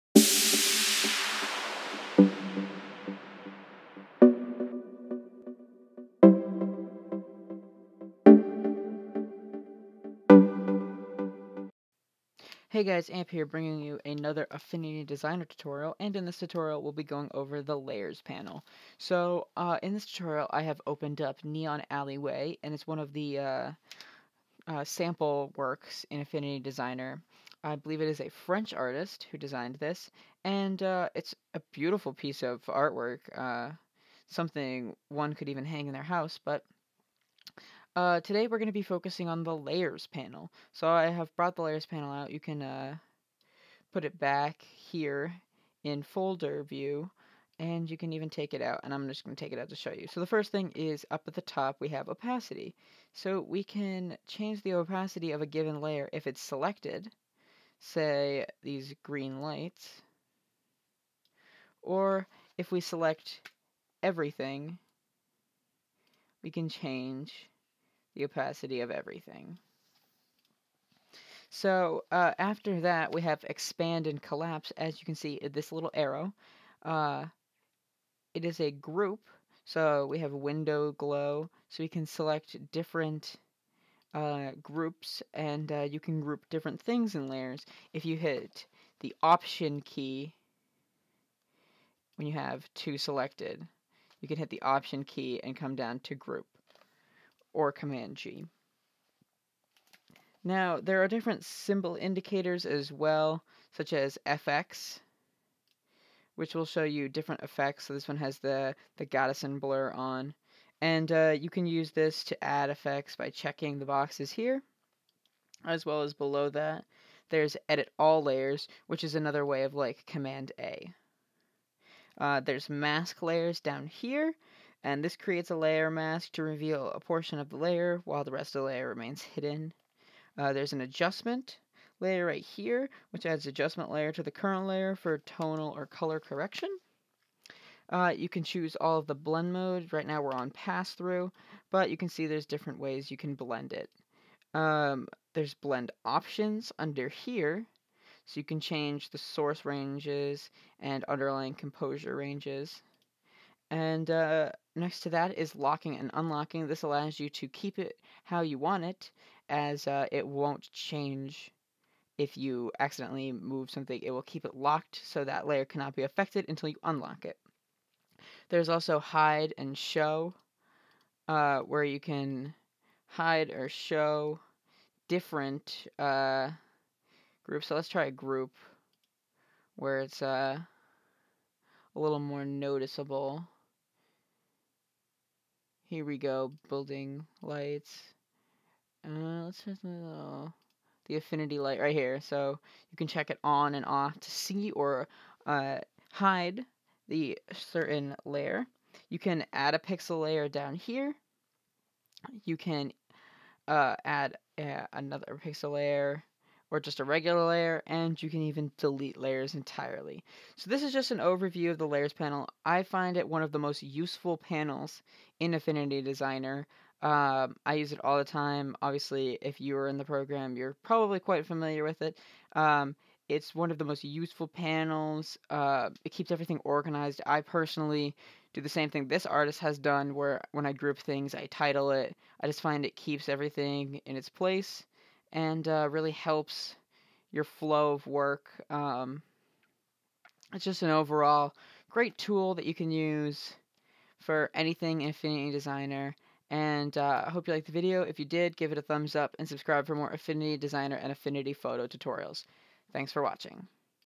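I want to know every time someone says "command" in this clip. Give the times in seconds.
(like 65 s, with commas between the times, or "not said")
97 s, 120 s.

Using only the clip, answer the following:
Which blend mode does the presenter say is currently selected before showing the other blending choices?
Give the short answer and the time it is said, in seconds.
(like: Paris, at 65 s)
Pass-through, at 140 s.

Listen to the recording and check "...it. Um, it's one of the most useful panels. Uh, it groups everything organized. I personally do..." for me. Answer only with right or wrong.
wrong.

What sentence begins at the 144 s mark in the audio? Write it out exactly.
Um, there's blend options under here, so you can change the source ranges and underlying composure ranges.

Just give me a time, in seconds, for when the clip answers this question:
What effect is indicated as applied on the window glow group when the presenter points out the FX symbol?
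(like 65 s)
109 s.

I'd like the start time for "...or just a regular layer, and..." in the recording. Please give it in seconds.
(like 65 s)
206 s.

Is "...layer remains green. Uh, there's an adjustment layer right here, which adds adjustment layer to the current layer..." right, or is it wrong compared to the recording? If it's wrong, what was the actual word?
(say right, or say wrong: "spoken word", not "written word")
wrong: "hidden", not "green".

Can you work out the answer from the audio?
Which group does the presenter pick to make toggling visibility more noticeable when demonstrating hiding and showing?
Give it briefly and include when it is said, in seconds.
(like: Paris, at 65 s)
Building lights, at 186 s.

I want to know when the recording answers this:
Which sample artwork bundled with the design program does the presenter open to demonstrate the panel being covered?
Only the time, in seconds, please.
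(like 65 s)
21 s.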